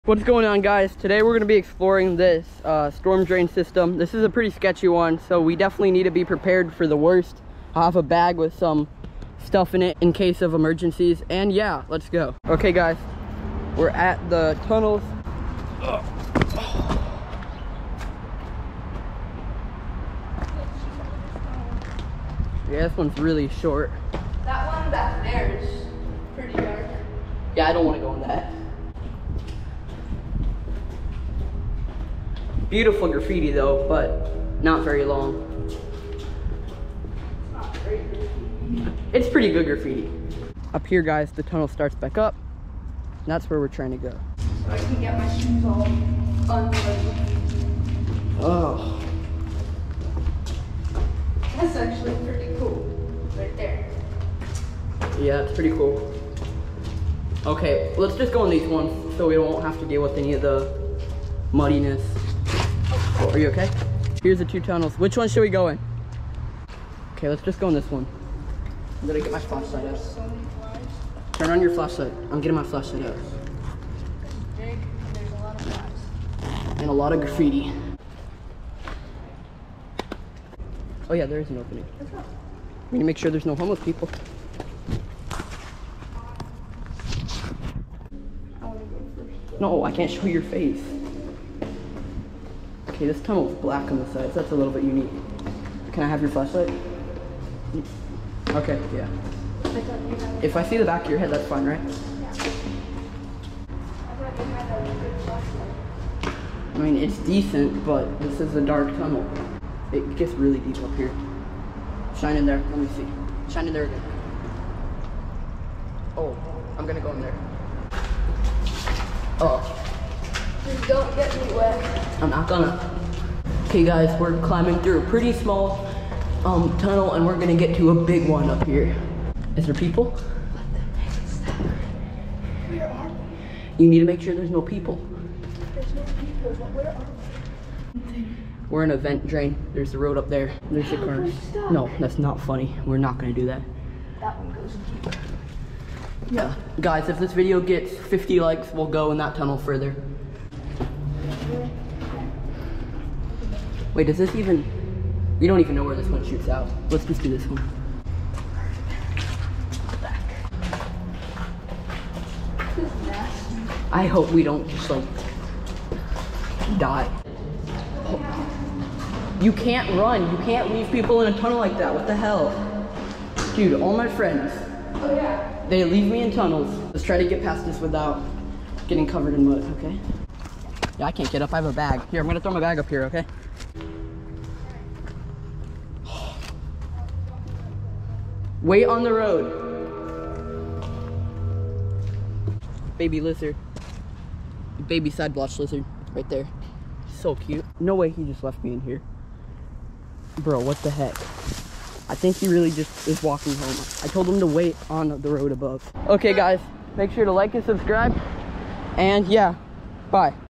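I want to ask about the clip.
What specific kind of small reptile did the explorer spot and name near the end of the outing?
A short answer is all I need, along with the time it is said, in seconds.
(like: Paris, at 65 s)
Side blotch lizard, at 195 s.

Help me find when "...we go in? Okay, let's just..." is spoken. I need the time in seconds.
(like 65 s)
65 s.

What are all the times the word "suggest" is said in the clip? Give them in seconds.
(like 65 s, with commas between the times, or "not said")
not said.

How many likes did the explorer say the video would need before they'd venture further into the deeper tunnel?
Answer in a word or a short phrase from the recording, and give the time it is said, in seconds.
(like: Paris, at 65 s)
50, at 147 s.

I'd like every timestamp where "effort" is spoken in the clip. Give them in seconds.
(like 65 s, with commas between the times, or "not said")
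not said.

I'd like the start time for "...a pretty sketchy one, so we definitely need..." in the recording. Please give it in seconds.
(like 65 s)
4 s.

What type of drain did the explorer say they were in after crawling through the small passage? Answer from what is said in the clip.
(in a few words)
Vent drain.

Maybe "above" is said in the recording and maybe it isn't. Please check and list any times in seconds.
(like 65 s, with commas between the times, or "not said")
205 s.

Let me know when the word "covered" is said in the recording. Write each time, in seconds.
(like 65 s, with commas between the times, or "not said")
179 s.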